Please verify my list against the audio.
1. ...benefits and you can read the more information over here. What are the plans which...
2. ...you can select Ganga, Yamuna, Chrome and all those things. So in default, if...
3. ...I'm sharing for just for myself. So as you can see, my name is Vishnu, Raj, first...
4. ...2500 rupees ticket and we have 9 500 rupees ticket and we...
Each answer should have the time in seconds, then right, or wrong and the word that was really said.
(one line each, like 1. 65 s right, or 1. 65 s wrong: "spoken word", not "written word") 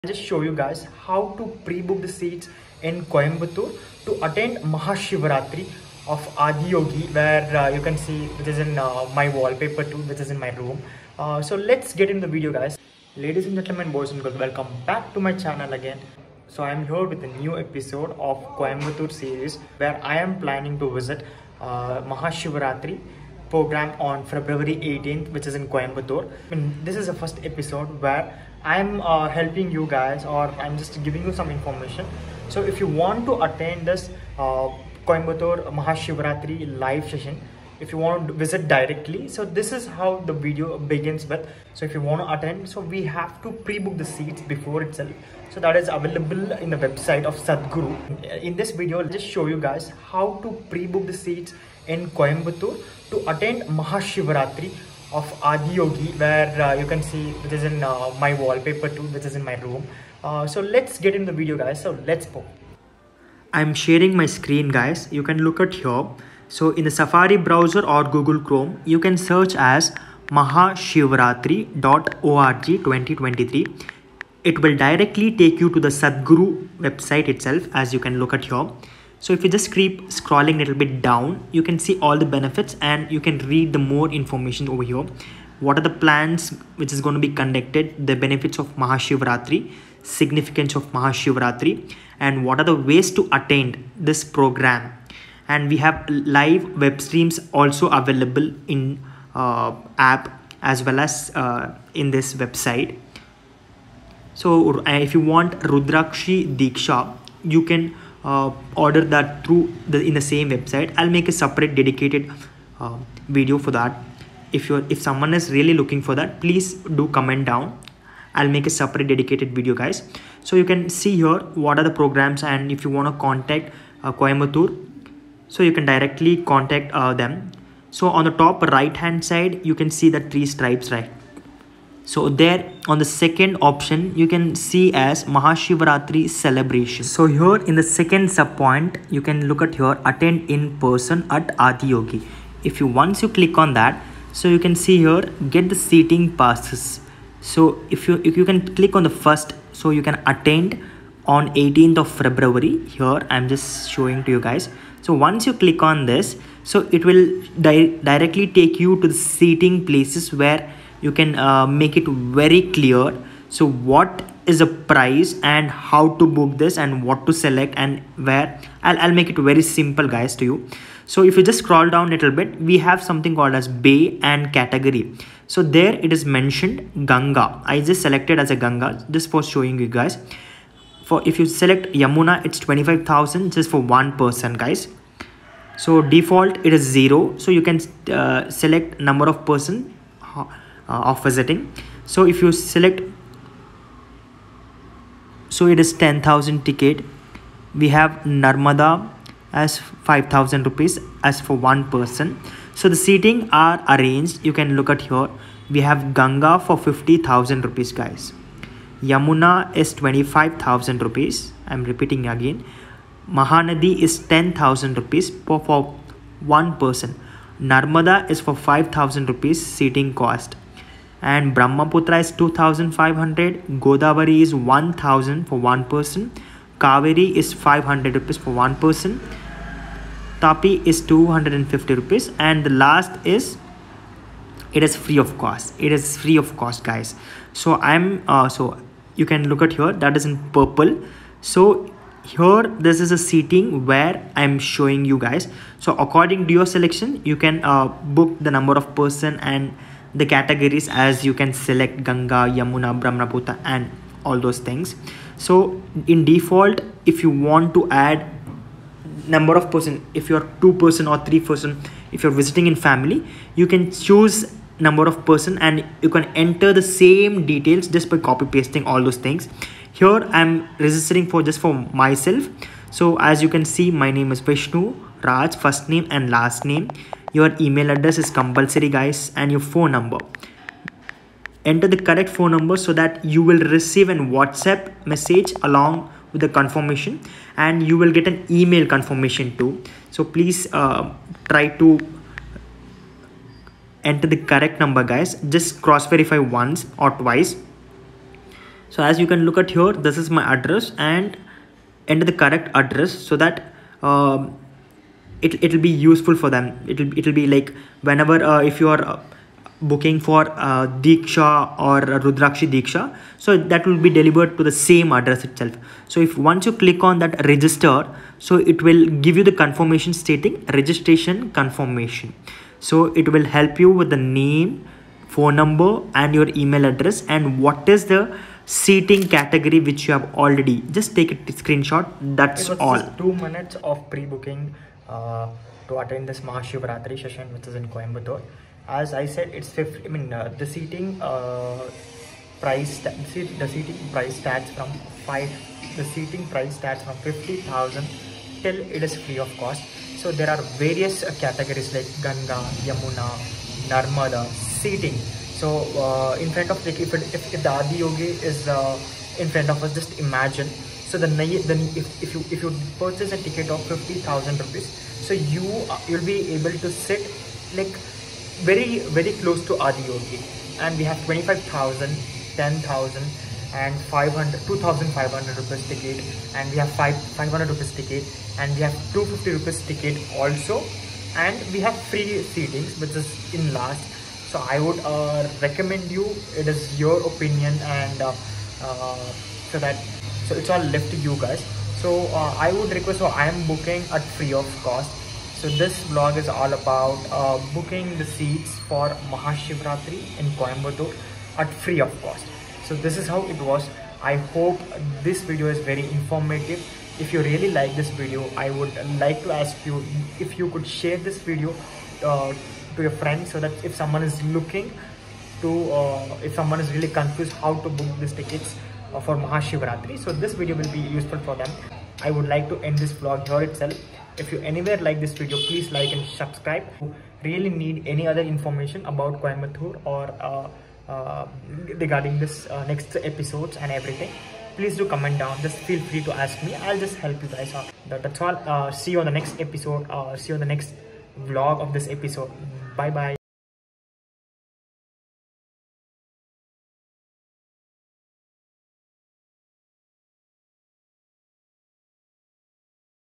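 1. 82 s right
2. 251 s wrong: "Brahmaputra", not "Chrome"
3. 270 s wrong: "registering", not "sharing"
4. 374 s wrong: "5", not "9".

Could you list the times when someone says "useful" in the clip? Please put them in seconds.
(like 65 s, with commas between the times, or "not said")
305 s, 420 s.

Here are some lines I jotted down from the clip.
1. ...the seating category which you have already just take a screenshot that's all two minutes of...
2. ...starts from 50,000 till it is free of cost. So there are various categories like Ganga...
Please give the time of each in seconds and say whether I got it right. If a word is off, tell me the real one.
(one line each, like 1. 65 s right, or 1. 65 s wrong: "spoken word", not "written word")
1. 328 s right
2. 346 s right.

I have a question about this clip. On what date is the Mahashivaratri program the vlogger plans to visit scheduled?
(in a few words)
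February 18th.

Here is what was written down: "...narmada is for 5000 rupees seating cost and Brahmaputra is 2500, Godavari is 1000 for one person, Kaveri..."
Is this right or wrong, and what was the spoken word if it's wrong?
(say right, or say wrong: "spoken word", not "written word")
right.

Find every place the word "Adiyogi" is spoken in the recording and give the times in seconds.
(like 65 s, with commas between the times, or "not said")
6 s, 55 s, 141 s.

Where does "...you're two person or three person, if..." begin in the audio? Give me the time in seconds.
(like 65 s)
260 s.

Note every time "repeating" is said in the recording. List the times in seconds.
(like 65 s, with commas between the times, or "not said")
211 s.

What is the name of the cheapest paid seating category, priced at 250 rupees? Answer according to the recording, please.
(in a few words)
Tapi.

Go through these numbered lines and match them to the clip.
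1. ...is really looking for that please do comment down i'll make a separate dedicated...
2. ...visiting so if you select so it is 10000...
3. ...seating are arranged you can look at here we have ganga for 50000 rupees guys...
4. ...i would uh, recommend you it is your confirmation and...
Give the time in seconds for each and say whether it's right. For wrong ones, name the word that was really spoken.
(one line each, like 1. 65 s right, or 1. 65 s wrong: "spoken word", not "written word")
1. 115 s right
2. 191 s right
3. 202 s right
4. 384 s wrong: "opinion", not "confirmation".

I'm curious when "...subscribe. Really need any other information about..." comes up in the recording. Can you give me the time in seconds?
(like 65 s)
426 s.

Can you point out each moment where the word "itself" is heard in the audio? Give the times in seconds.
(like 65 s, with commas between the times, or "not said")
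44 s, 77 s, 315 s, 423 s.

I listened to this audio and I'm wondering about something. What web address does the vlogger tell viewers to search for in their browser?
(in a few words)
mahashivaratri.org 2023.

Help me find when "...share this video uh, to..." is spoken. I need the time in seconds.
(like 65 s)
410 s.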